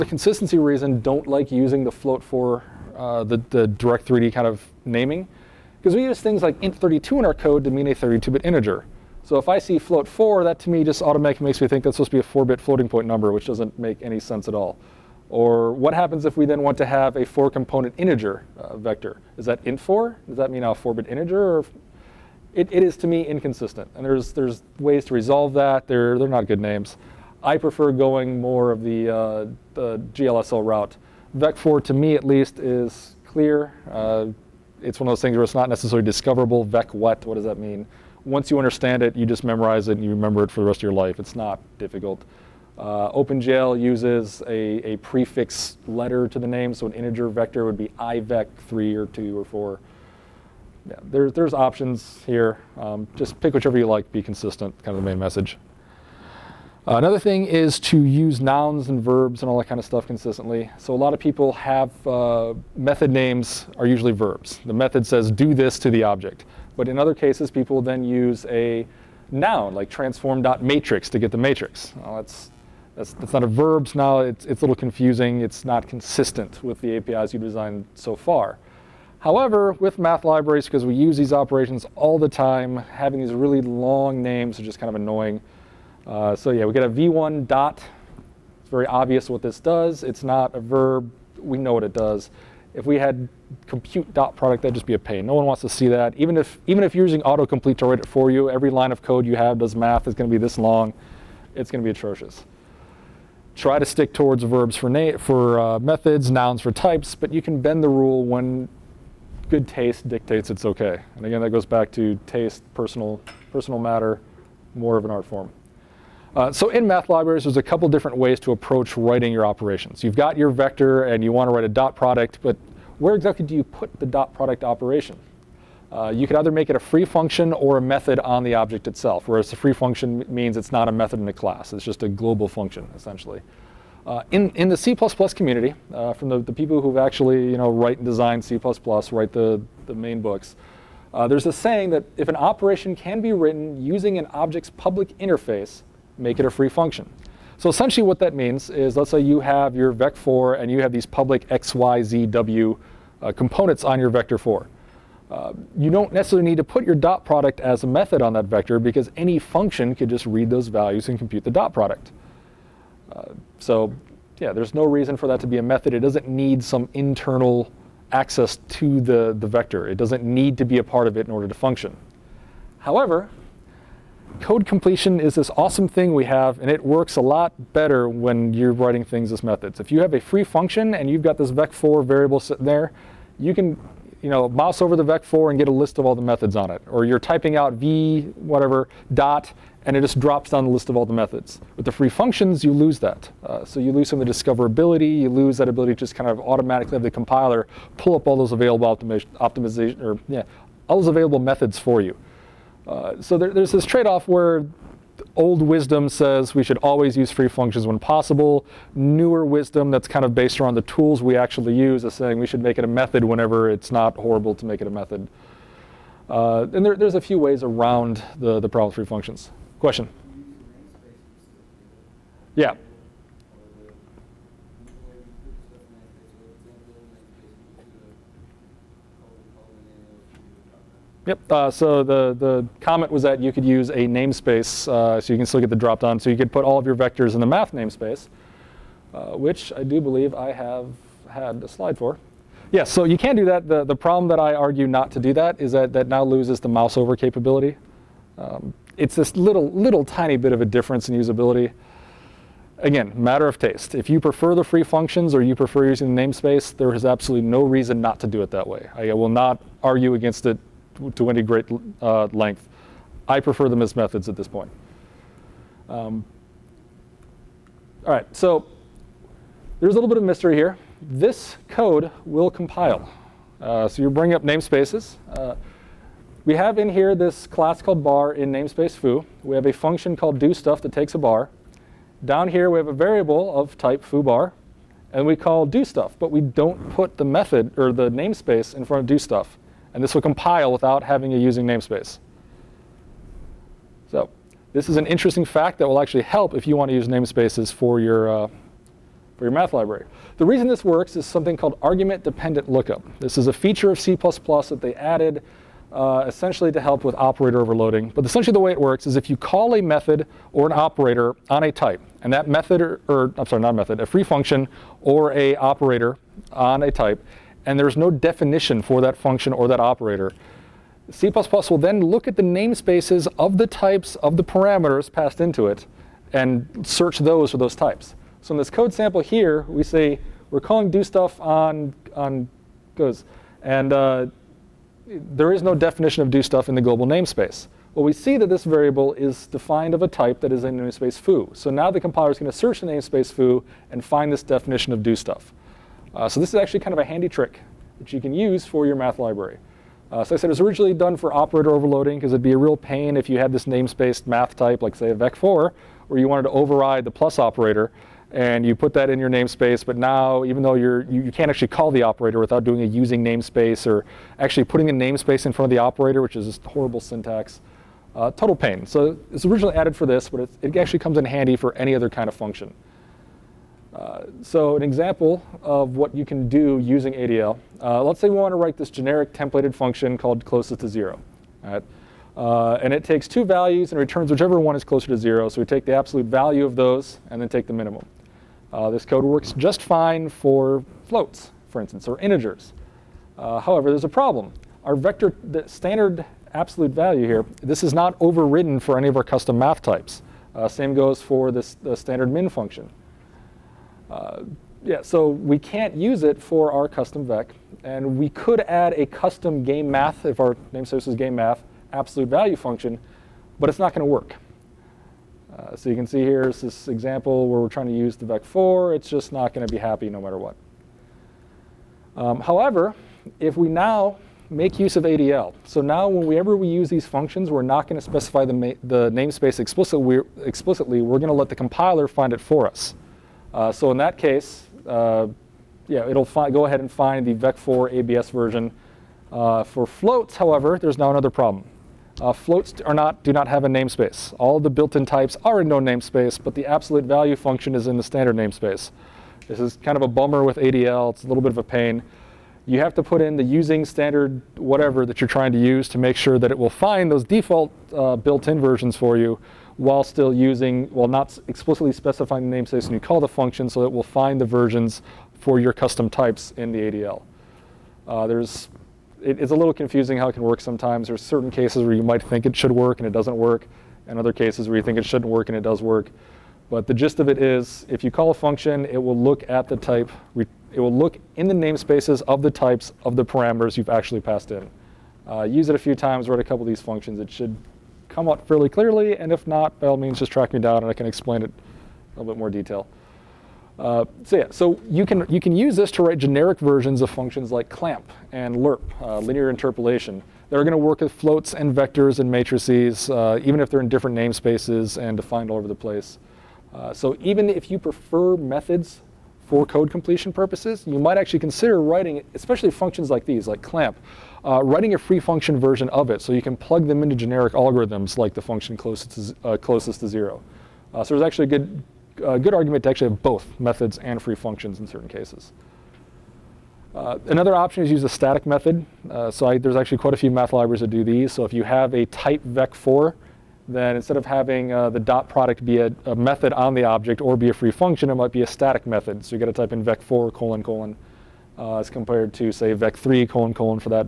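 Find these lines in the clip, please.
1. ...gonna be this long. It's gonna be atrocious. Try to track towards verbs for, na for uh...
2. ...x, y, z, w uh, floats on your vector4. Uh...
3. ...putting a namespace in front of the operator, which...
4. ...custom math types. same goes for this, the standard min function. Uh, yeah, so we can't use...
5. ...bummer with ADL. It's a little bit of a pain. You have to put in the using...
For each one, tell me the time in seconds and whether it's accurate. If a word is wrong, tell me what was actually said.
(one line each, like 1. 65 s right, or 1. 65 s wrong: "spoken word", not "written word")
1. 100 s wrong: "stick", not "track"
2. 151 s wrong: "components", not "floats"
3. 364 s right
4. 399 s right
5. 450 s right.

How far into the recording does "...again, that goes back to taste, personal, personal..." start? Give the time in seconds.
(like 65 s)
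111 s.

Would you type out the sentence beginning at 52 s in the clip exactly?
Um, just pick whichever you like, be consistent, kind of the main message.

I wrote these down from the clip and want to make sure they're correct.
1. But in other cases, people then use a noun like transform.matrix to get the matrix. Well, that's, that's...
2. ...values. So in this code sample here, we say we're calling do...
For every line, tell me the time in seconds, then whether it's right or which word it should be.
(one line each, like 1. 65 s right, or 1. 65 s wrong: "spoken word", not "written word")
1. 66 s right
2. 327 s wrong: "types", not "values".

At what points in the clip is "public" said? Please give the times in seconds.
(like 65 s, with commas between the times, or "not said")
144 s, 151 s.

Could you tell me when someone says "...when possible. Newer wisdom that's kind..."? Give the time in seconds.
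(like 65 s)
207 s.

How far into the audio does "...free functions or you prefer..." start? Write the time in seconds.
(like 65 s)
254 s.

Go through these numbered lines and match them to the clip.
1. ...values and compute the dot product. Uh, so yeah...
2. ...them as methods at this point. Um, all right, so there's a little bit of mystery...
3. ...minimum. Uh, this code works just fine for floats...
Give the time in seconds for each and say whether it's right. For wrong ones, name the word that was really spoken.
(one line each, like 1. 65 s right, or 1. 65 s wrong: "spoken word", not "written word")
1. 160 s right
2. 263 s right
3. 387 s right.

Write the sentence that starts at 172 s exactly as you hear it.
However, Code completion is this awesome thing we have, and it works a lot better when you're writing things as methods.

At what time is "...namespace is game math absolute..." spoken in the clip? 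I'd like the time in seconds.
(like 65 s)
410 s.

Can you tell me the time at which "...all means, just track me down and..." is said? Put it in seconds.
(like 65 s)
489 s.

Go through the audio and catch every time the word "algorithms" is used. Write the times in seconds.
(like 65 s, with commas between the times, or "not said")
517 s.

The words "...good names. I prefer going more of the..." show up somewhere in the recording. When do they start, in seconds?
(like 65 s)
26 s.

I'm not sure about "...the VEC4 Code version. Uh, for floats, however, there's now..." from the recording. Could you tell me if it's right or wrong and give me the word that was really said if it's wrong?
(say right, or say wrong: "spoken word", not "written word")
wrong: "ABS", not "Code".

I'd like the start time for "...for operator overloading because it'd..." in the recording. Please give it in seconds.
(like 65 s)
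351 s.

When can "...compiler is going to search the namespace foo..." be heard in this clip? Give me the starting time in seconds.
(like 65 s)
341 s.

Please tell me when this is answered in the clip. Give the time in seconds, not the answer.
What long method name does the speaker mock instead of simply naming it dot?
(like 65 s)
93 s.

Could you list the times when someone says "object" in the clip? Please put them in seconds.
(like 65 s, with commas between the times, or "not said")
66 s, 128 s, 144 s, 536 s.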